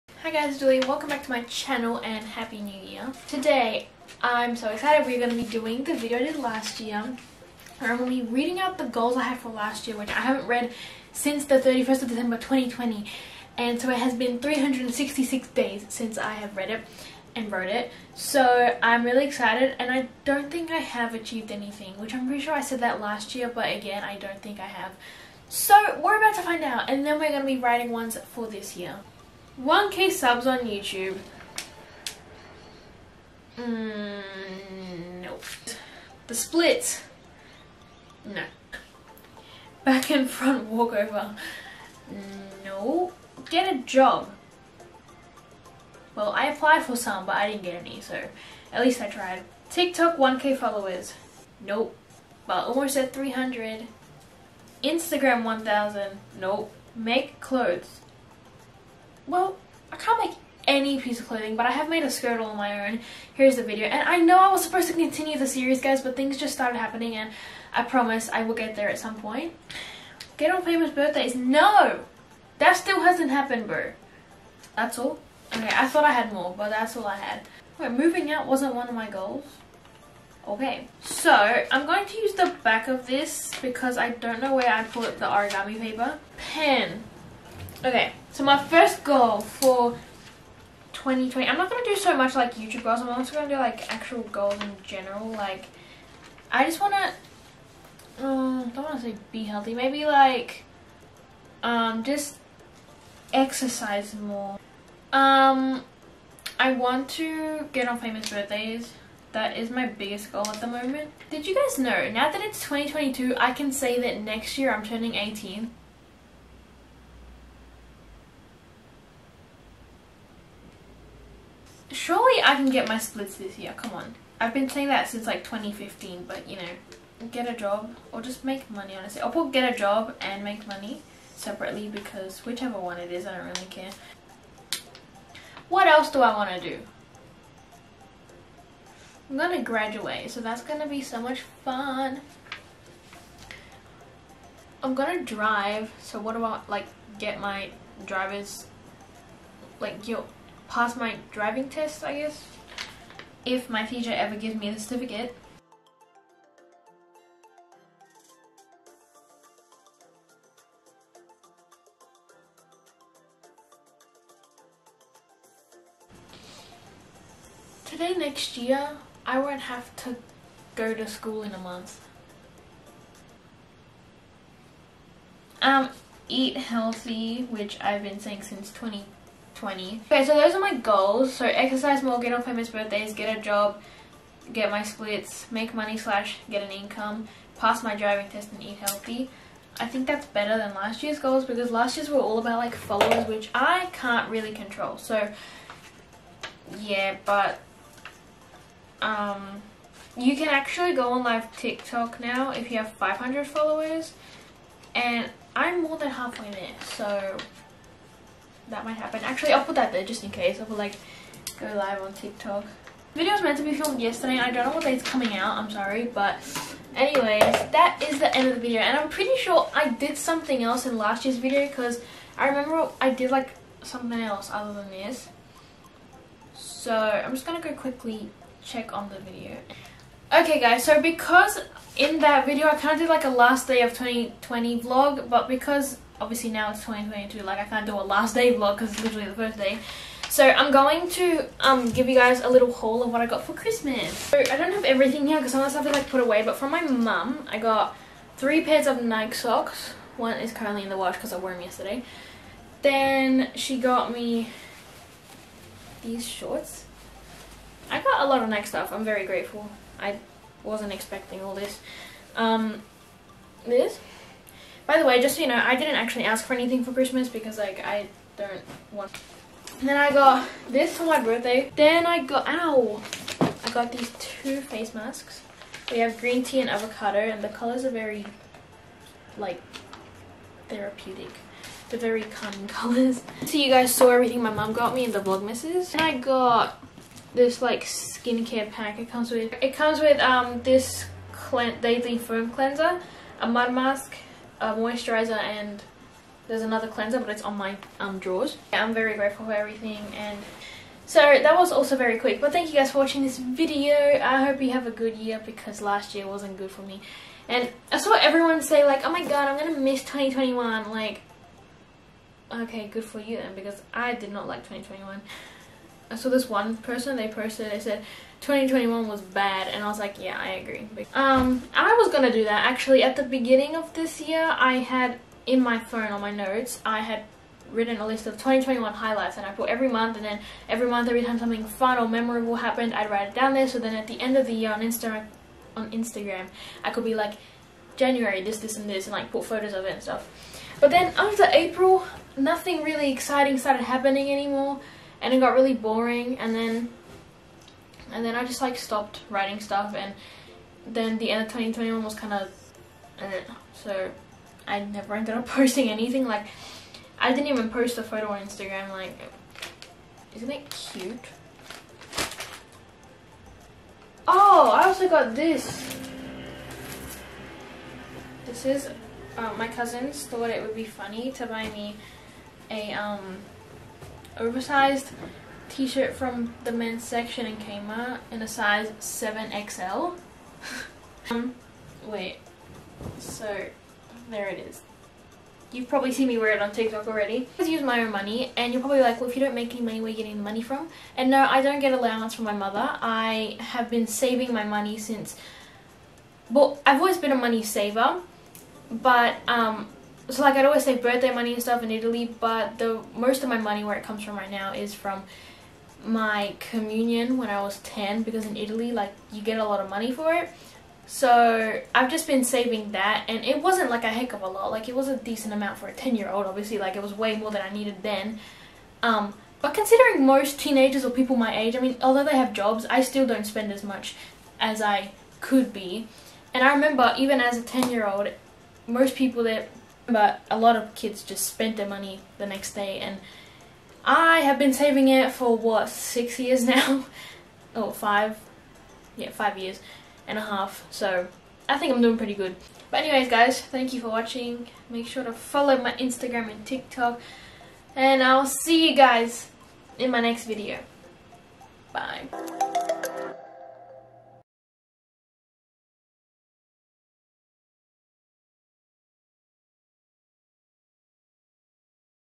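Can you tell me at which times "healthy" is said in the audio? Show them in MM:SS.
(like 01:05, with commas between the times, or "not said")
01:39, 02:56, 03:08.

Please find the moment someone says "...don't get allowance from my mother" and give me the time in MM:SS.
06:31.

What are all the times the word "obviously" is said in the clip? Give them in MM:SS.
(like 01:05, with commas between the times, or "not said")
03:56, 06:56.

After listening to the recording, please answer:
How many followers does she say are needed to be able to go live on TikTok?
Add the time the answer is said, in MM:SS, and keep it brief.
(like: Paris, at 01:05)
500, at 03:22.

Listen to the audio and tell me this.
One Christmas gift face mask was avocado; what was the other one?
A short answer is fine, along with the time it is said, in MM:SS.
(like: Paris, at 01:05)
Green tea, at 04:36.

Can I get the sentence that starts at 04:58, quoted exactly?
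Yeah, I'm very grateful for everything and so that was also very quick but thank you guys for watching this video.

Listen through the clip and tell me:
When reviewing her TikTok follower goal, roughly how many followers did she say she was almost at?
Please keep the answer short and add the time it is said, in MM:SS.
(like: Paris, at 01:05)
300, at 00:52.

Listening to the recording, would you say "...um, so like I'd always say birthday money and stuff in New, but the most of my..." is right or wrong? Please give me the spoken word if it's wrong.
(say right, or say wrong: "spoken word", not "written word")
wrong: "Italy", not "New".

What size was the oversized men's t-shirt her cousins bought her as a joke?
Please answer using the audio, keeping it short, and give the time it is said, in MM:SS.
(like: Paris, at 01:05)
7XL, at 06:18.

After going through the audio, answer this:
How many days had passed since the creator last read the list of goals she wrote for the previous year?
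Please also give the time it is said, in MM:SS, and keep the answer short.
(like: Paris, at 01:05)
366, at 00:14.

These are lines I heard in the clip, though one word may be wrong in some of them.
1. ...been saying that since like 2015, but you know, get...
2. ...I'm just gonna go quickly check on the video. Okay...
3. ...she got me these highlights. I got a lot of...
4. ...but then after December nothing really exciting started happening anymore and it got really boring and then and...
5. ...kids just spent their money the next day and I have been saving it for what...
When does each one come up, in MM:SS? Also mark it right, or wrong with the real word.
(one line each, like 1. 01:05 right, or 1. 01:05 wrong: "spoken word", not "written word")
1. 02:04 right
2. 03:46 right
3. 04:13 wrong: "shorts", not "highlights"
4. 05:40 wrong: "April", not "December"
5. 07:10 right.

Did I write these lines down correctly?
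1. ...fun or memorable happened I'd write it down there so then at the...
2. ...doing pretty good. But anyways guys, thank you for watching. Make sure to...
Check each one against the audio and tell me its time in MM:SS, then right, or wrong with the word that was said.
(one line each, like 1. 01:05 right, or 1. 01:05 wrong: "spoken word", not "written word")
1. 05:31 right
2. 07:22 right.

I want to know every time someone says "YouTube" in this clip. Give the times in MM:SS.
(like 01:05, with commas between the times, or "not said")
00:30, 01:32.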